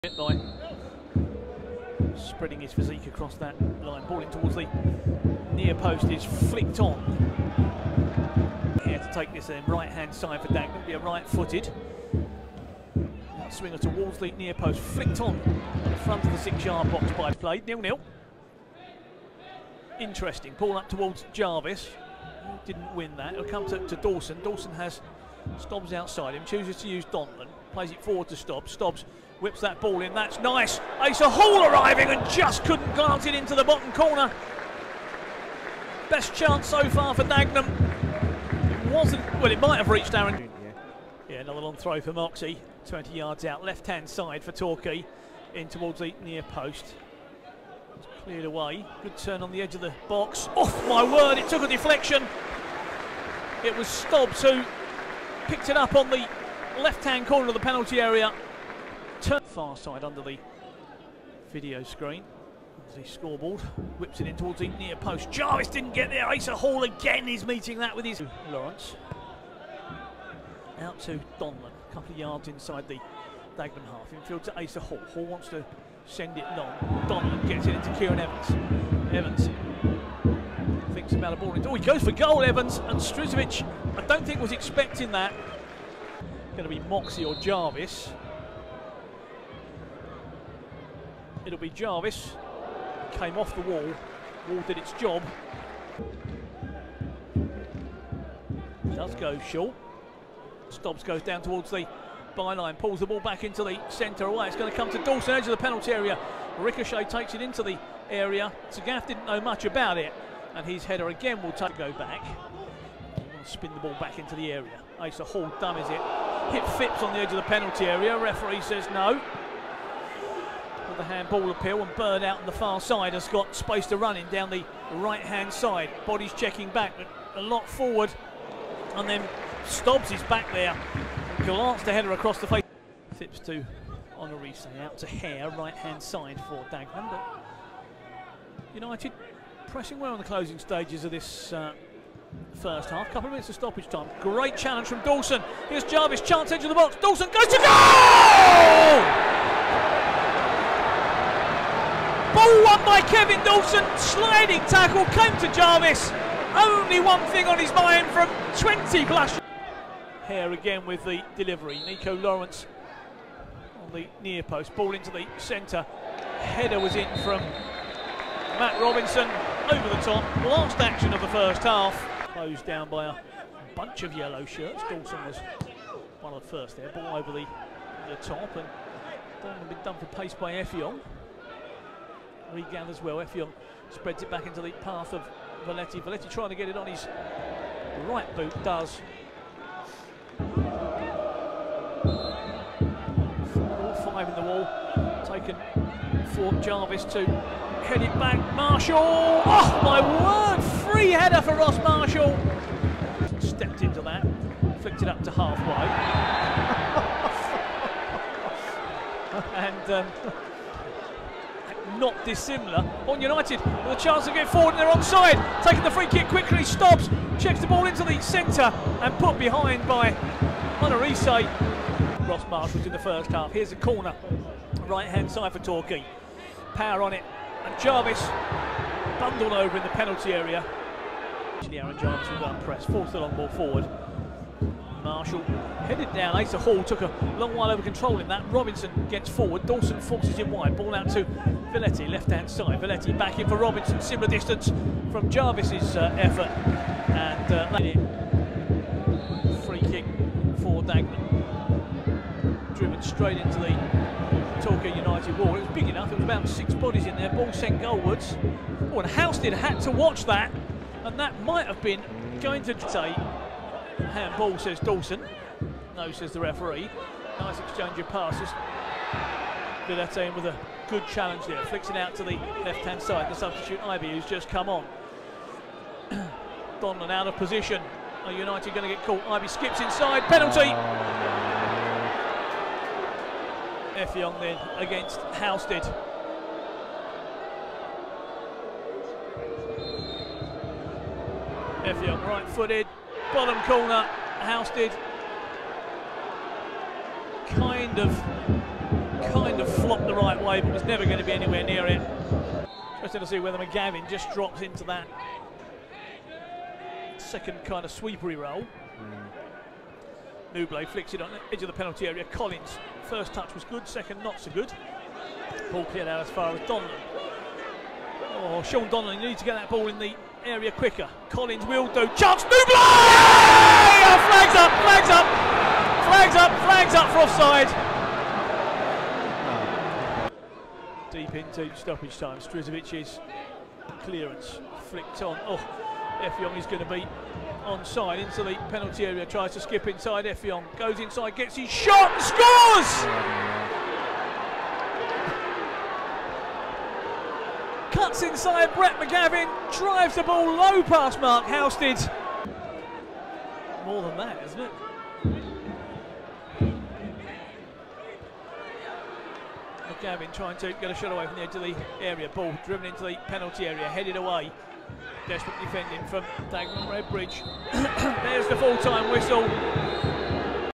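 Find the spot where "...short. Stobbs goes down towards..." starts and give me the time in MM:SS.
01:39.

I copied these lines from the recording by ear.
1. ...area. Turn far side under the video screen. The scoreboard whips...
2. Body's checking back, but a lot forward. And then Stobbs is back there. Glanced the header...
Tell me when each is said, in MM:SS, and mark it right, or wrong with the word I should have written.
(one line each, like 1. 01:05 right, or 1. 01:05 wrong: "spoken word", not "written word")
1. 00:57 right
2. 02:06 right.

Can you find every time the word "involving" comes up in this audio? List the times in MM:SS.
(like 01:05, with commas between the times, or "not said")
not said.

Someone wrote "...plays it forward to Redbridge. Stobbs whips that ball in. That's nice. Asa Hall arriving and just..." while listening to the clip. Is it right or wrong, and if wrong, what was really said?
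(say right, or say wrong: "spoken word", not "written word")
wrong: "Stobbs", not "Redbridge".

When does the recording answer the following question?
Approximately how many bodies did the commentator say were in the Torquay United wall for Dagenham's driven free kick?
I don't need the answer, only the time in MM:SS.
04:16.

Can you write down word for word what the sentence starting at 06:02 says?
Ball driven into the penalty area, headed away Desperate defending from Dagenham Redbridge.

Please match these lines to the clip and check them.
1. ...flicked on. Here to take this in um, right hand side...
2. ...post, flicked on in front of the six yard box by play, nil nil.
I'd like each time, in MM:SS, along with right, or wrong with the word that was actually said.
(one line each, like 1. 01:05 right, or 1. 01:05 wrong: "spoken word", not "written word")
1. 00:06 right
2. 00:14 right.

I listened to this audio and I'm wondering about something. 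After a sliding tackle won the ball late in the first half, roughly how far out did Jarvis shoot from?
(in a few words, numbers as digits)
20 plus.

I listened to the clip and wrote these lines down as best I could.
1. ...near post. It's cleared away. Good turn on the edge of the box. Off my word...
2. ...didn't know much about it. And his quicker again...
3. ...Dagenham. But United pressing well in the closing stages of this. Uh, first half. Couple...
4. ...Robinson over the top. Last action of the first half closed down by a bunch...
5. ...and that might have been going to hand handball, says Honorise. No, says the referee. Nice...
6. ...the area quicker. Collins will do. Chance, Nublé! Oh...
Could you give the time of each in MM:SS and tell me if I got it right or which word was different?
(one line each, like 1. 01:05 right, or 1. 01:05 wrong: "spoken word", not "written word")
1. 00:46 right
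2. 01:49 wrong: "header", not "quicker"
3. 02:16 right
4. 02:48 right
5. 04:21 wrong: "Dawson", not "Honorise"
6. 05:19 right.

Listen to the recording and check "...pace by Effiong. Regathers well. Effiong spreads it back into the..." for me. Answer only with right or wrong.
right.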